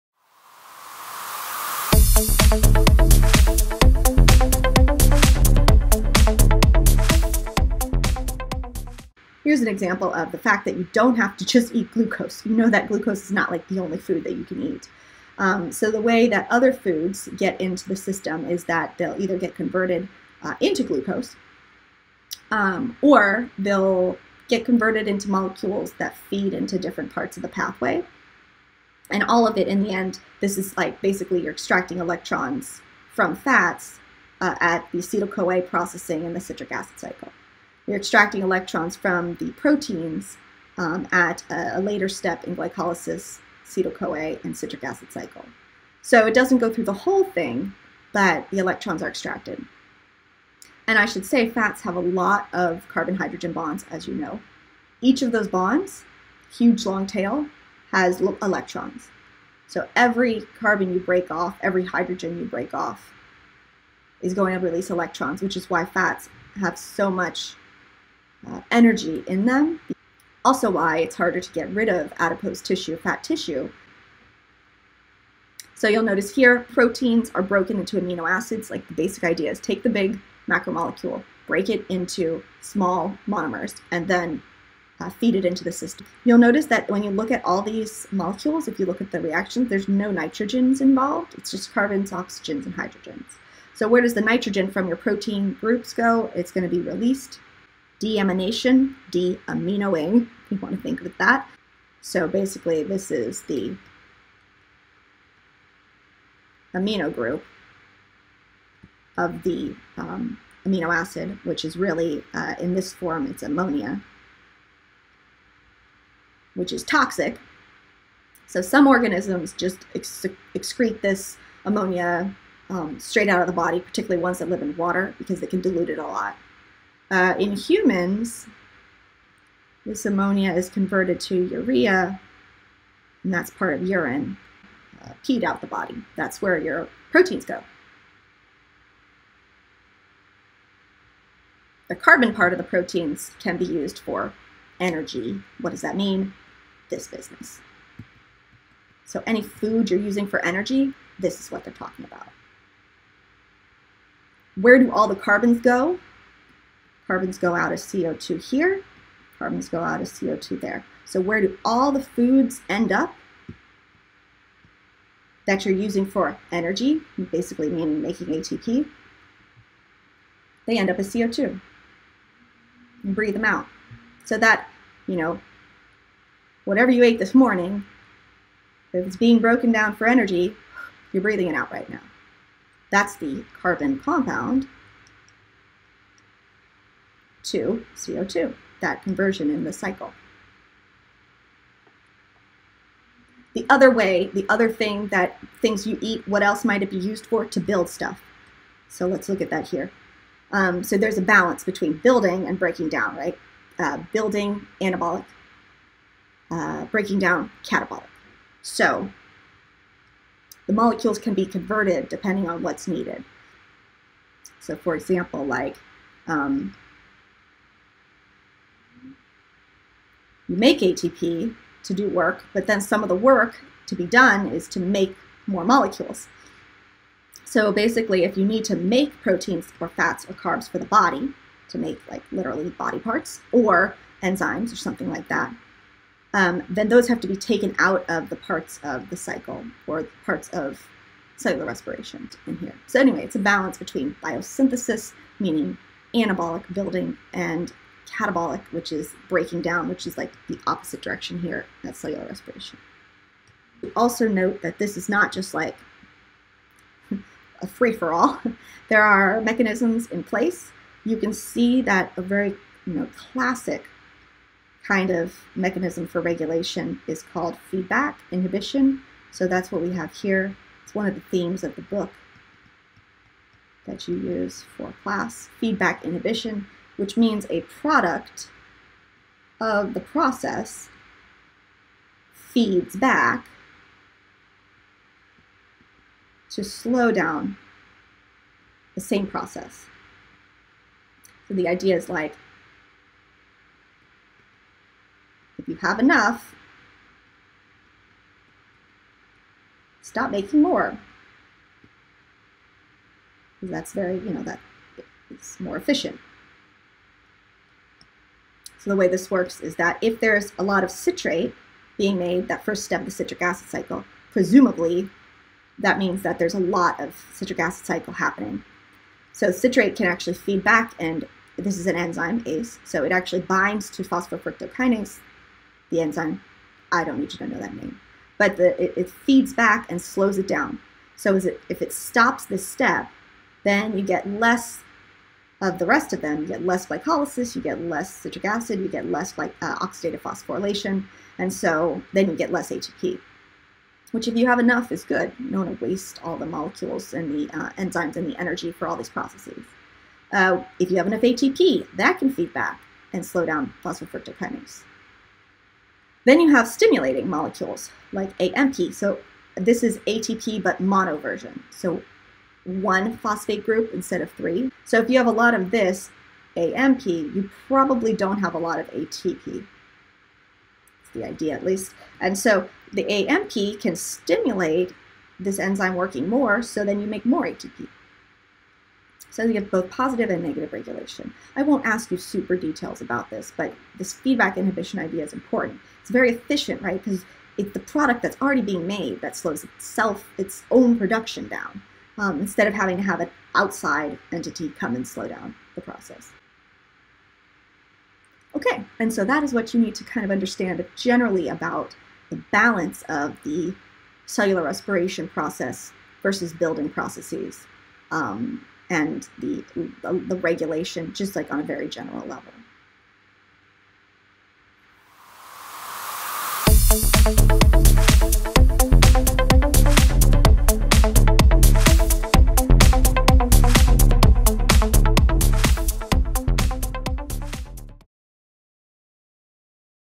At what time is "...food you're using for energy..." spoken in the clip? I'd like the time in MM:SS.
02:29.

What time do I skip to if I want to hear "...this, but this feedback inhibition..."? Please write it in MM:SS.
06:23.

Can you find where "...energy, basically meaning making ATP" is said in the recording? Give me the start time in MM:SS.
02:46.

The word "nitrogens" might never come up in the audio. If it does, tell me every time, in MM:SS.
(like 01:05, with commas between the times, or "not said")
01:30, 01:34.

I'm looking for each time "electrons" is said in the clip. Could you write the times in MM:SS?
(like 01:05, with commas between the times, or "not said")
00:31, 00:38, 00:48, 00:58, 01:04.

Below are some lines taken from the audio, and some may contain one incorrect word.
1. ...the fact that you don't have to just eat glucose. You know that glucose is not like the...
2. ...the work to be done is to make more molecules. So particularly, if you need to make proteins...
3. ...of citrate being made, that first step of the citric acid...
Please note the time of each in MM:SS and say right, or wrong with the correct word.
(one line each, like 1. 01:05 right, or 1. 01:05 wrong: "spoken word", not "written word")
1. 00:10 right
2. 03:43 wrong: "basically", not "particularly"
3. 05:10 right.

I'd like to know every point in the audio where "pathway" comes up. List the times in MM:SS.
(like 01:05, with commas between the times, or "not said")
00:27.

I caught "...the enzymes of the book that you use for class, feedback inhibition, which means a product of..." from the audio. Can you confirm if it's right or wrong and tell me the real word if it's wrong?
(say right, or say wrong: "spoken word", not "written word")
wrong: "themes", not "enzymes".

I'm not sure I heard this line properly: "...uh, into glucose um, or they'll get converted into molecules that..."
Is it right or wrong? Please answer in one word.
right.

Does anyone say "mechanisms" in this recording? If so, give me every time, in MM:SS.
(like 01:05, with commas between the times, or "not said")
04:19, 04:25.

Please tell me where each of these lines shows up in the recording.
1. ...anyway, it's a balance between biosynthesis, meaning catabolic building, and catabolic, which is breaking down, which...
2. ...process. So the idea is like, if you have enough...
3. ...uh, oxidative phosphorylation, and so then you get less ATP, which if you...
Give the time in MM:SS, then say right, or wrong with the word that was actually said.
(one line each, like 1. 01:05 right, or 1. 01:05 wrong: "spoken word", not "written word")
1. 04:02 wrong: "anabolic", not "catabolic"
2. 04:49 right
3. 05:39 right.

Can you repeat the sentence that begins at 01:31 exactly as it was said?
It's just carbons, oxygens, and hydrogens.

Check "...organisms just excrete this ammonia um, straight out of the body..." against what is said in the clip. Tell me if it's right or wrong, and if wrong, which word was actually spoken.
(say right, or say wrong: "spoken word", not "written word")
right.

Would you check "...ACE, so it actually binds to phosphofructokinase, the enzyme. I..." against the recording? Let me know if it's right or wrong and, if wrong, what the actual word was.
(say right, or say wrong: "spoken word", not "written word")
right.